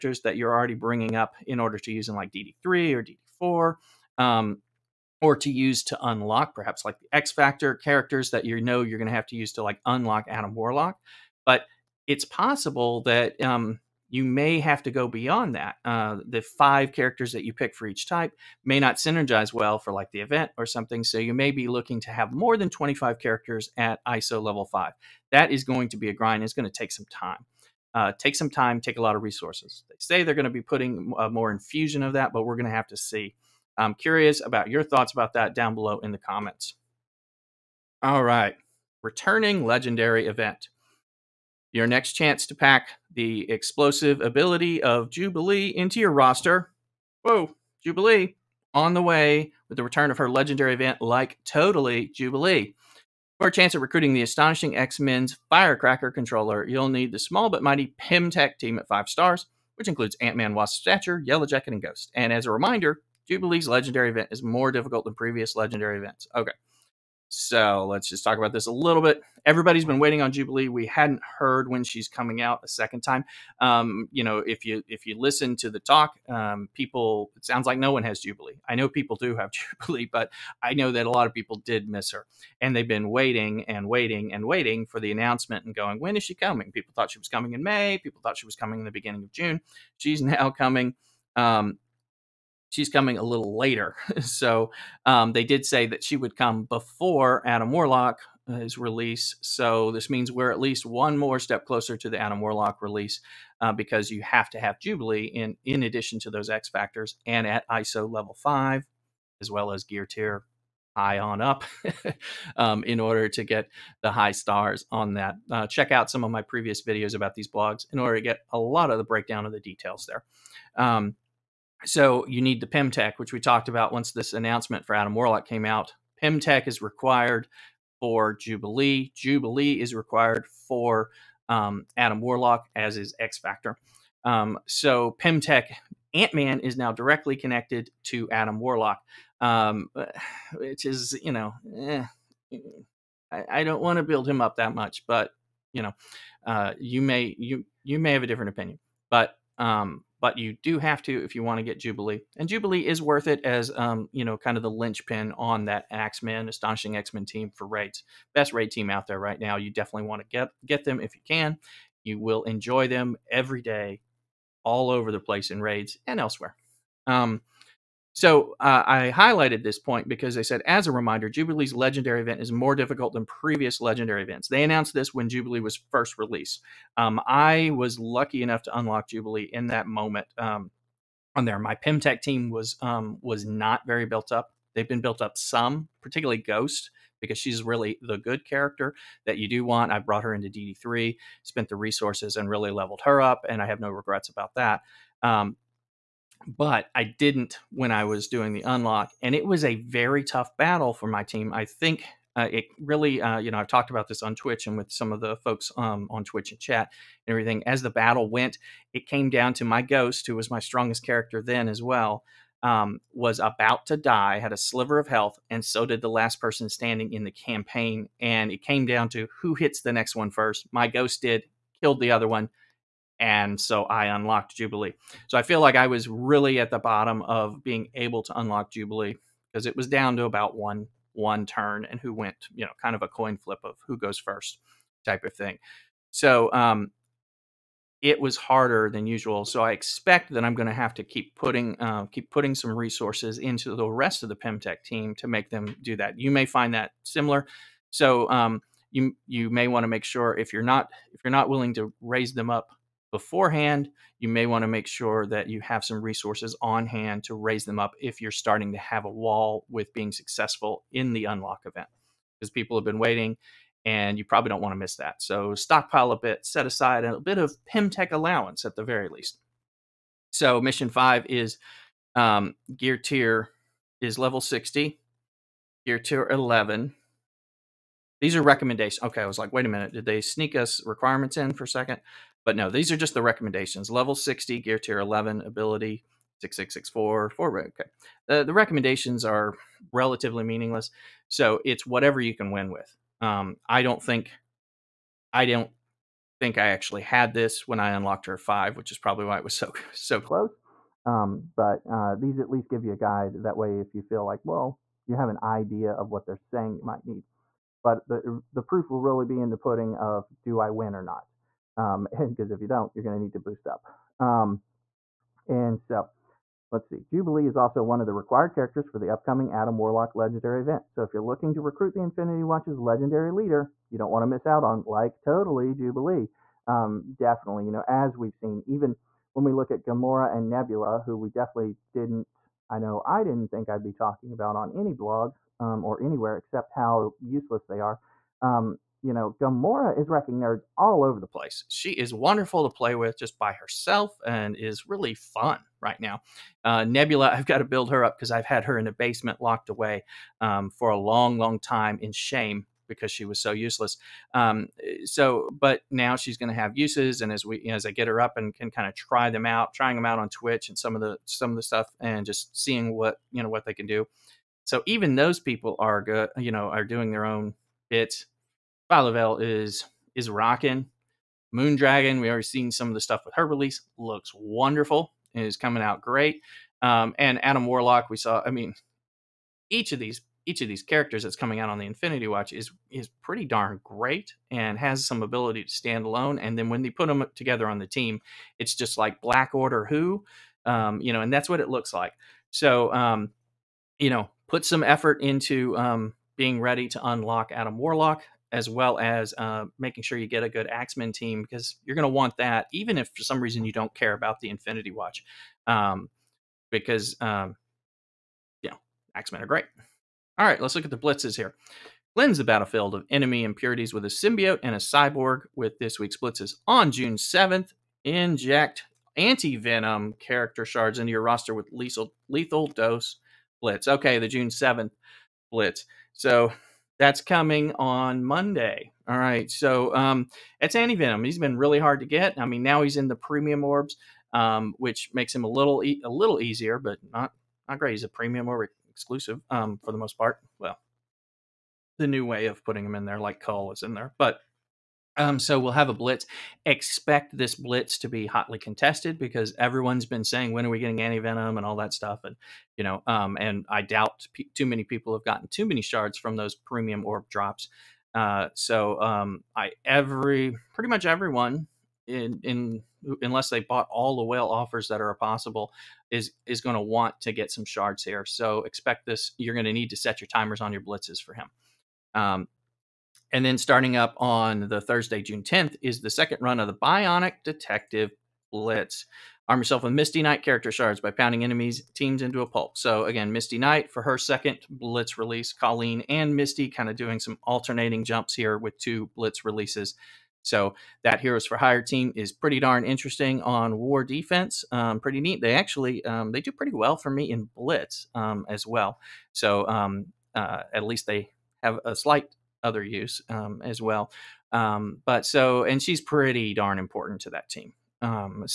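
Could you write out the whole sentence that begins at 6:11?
Moondragon, we already seen some of the stuff with her release.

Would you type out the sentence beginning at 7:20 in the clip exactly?
Well, the new way of putting him in there, like Cull is in there, but um, so we'll have a blitz.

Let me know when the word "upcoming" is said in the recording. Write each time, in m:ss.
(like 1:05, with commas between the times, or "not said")
5:19.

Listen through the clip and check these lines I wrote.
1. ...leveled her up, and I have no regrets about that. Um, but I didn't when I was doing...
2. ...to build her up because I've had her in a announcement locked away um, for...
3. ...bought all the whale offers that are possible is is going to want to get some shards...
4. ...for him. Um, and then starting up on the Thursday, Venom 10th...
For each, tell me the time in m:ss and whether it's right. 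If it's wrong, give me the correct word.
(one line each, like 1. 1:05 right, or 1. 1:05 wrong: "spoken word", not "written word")
1. 3:12 right
2. 5:47 wrong: "basement", not "announcement"
3. 7:43 right
4. 7:51 wrong: "June", not "Venom".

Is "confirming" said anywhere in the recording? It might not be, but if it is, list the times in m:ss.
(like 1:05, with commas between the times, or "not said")
not said.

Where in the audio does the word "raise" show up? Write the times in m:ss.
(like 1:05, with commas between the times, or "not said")
4:12, 4:17.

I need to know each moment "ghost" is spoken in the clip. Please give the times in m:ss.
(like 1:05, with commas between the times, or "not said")
1:01, 3:06, 3:29, 3:40.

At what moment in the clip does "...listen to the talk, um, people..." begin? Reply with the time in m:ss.
1:15.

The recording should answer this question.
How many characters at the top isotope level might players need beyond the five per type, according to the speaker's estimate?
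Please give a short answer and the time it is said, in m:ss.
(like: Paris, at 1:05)
more than 25, at 0:22.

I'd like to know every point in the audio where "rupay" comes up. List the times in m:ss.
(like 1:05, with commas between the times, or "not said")
not said.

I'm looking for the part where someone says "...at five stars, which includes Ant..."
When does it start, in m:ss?
0:58.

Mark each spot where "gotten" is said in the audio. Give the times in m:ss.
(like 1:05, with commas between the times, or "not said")
7:35.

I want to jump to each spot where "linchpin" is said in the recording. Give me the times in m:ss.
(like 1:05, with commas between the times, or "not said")
2:34.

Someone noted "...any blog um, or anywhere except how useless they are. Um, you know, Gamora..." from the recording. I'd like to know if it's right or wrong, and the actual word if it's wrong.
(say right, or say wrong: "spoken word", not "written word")
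right.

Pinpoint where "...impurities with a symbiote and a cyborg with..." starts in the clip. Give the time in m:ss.
6:53.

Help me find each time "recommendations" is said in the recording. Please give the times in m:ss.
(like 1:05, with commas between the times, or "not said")
4:38, 4:43, 4:48.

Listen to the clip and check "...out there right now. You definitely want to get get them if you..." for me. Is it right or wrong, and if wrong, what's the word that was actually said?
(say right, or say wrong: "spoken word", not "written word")
right.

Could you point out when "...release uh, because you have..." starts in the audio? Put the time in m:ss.
1:42.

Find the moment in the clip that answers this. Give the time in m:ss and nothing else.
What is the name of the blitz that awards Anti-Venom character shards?
7:02.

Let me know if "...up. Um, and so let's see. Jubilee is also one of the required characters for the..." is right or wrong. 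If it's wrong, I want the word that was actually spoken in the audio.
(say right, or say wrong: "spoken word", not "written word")
right.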